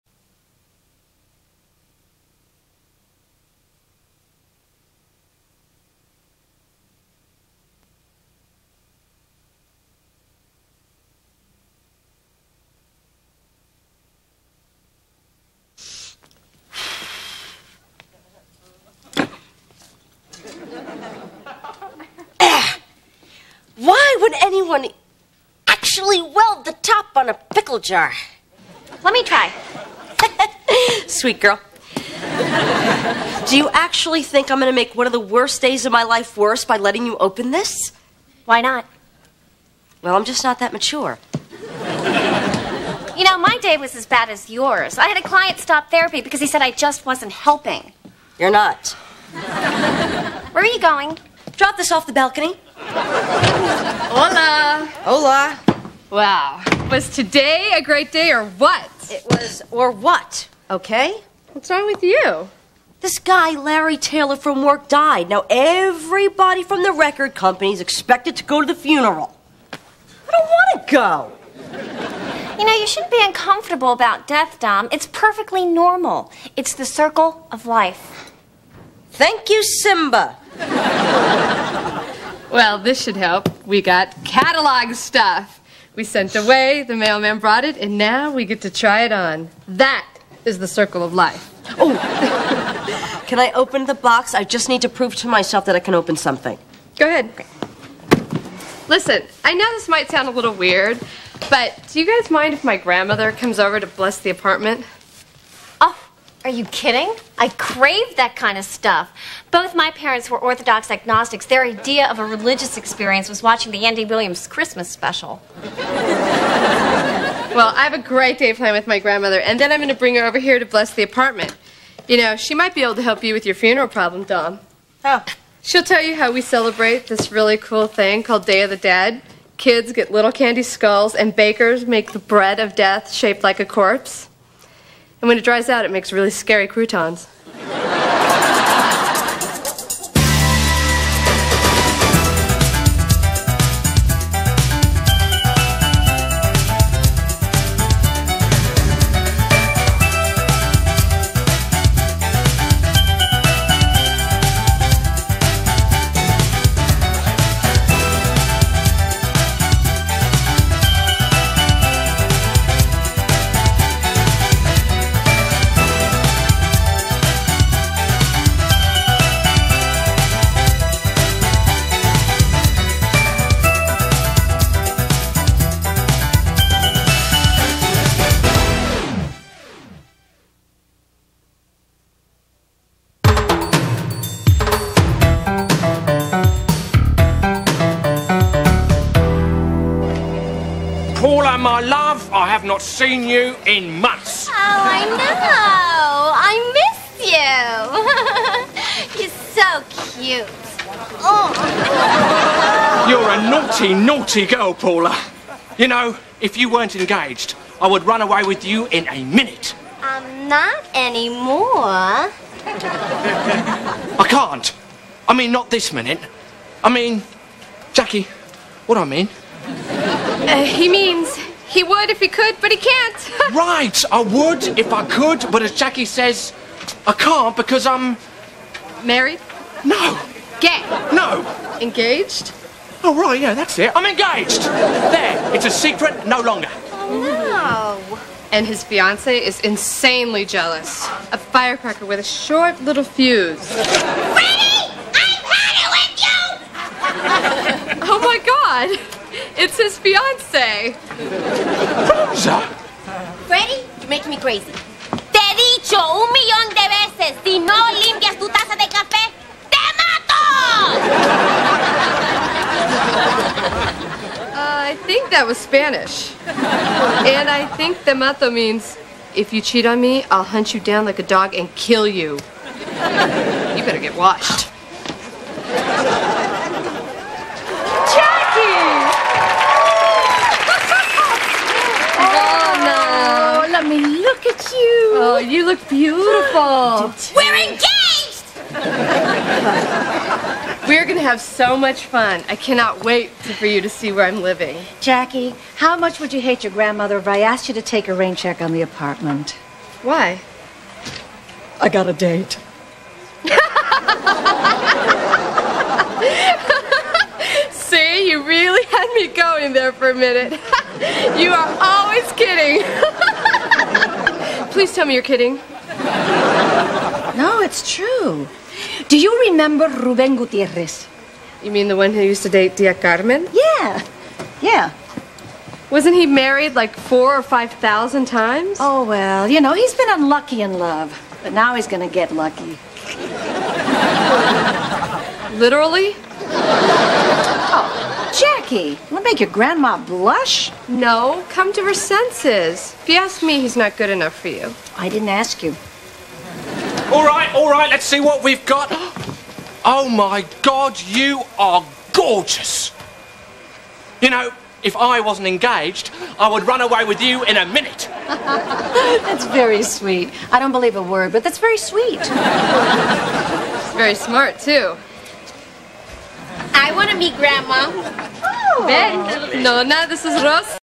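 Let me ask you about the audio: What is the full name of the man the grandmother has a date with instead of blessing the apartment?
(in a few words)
Ruben Gutierrez.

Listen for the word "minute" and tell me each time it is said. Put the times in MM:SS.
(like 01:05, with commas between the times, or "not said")
03:29, 03:35, 05:10, 05:57.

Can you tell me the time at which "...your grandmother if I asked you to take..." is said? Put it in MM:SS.
04:56.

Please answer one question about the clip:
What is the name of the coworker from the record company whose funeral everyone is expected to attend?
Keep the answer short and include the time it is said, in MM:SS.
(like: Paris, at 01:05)
Larry Taylor, at 01:03.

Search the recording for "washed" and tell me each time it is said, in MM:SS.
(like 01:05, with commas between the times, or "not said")
04:34.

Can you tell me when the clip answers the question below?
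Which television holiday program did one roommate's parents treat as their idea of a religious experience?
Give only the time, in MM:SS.
01:53.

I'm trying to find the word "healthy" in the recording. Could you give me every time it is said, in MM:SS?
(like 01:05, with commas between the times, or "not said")
not said.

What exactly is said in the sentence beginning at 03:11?
my love, I have not seen you in months.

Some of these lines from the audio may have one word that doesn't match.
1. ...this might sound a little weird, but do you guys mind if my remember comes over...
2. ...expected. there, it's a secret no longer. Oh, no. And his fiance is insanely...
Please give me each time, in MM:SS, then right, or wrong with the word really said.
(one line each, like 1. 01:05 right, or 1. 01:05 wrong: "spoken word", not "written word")
1. 01:39 wrong: "grandmother", not "remember"
2. 03:54 wrong: "engaged", not "expected".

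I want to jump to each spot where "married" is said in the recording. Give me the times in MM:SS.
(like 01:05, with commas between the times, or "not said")
03:49, 05:26.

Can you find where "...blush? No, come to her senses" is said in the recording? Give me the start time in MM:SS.
05:40.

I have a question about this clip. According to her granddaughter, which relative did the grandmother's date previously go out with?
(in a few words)
Tia Carmen.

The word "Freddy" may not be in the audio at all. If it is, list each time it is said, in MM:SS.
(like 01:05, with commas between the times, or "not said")
04:03, 04:13.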